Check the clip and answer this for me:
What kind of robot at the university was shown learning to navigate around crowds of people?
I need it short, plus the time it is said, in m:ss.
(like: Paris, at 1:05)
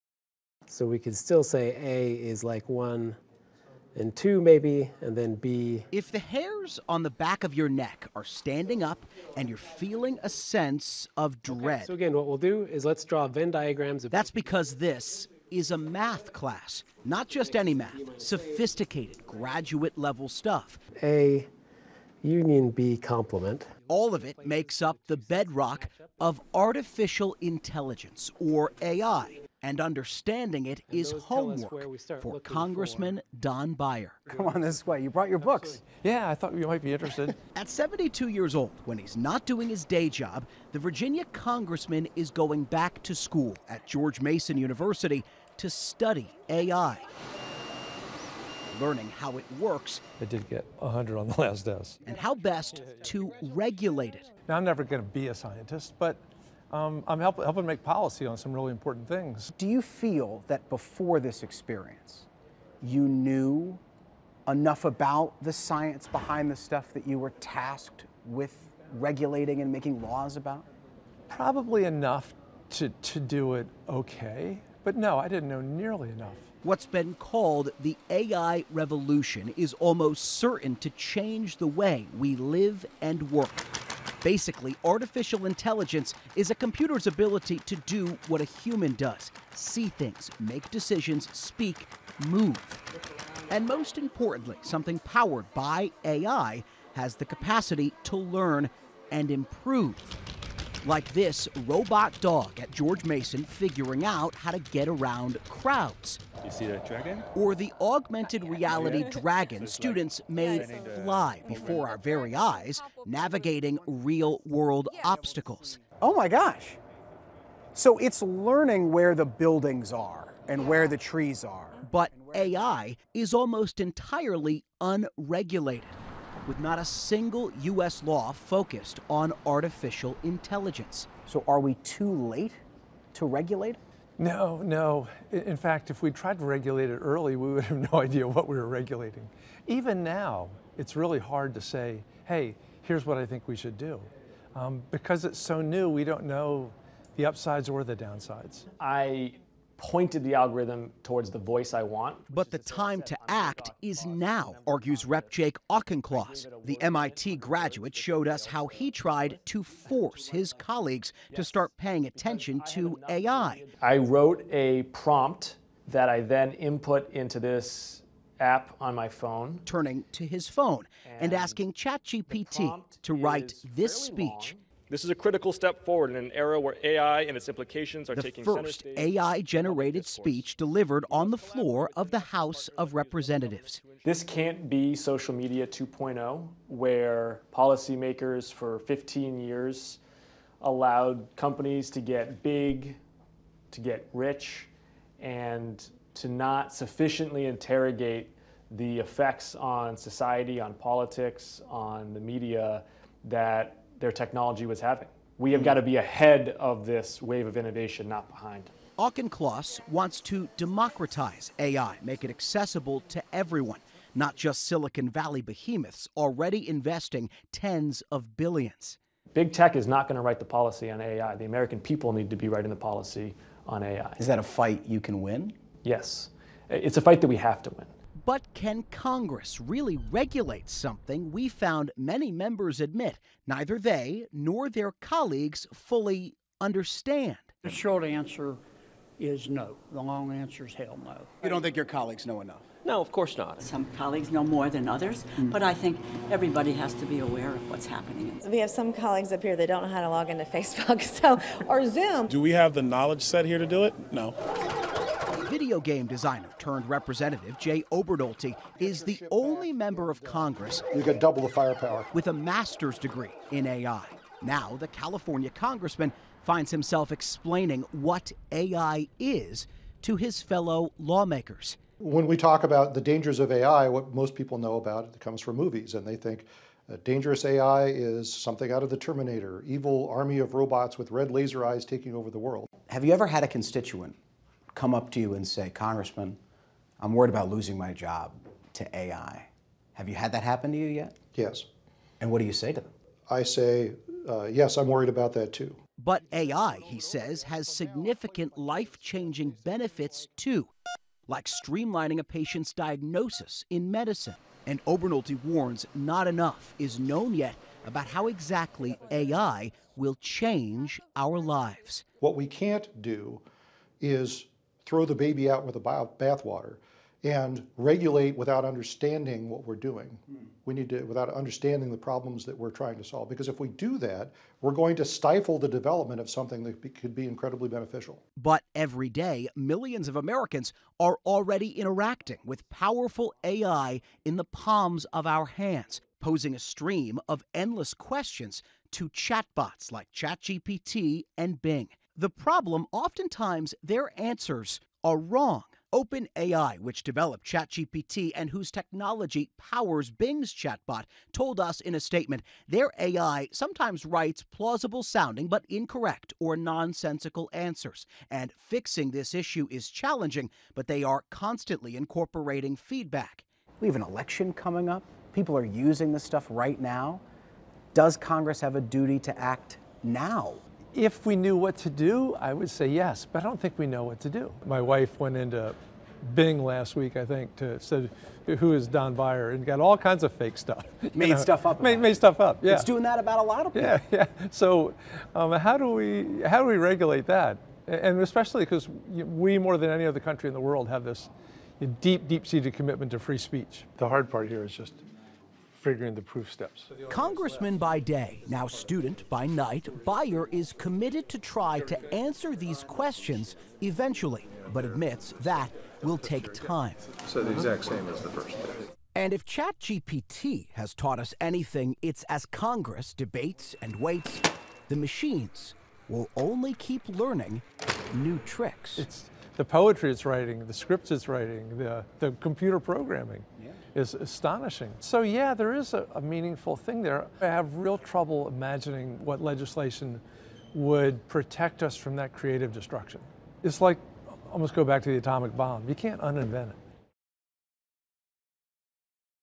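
robot dog, at 1:41.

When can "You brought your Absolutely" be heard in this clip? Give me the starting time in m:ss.
0:35.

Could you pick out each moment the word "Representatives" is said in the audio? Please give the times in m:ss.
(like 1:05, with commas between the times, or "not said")
3:02, 4:16.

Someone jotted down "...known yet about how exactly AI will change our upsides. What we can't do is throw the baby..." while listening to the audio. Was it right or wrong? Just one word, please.
wrong.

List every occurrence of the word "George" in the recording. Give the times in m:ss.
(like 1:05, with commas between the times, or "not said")
0:43, 1:42.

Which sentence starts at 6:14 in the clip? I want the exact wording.
My wife went into Bing last week, I think, to said who is Don Beyer and got all kinds of fake stuff.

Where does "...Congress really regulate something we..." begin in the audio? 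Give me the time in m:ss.
3:48.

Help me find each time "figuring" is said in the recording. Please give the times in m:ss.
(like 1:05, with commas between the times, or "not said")
1:43, 6:35.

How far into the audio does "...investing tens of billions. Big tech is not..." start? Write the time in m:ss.
3:36.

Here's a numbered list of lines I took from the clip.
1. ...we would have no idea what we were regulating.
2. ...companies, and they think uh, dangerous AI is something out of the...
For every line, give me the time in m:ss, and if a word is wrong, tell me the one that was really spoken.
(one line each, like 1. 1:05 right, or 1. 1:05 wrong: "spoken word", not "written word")
1. 2:17 right
2. 4:35 wrong: "movies", not "companies".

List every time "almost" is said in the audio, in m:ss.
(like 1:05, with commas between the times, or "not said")
1:19, 2:03, 7:14.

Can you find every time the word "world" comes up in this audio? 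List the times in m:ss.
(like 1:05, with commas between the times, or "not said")
1:54, 4:42, 6:30.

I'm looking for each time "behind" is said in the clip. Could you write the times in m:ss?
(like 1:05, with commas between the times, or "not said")
1:06, 3:28.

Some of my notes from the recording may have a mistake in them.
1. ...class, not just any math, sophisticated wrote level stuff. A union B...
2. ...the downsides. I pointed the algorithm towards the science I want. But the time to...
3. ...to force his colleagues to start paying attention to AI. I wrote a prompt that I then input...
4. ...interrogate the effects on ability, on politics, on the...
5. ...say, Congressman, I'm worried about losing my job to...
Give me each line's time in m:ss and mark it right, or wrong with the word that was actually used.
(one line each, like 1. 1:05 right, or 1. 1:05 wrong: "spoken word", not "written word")
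1. 0:16 wrong: "graduate", not "wrote"
2. 2:27 wrong: "voice", not "science"
3. 2:39 right
4. 3:17 wrong: "society", not "ability"
5. 4:45 right.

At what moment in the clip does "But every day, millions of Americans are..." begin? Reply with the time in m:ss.
5:28.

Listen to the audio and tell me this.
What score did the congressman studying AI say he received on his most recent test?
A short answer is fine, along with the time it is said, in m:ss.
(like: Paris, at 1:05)
100, at 0:50.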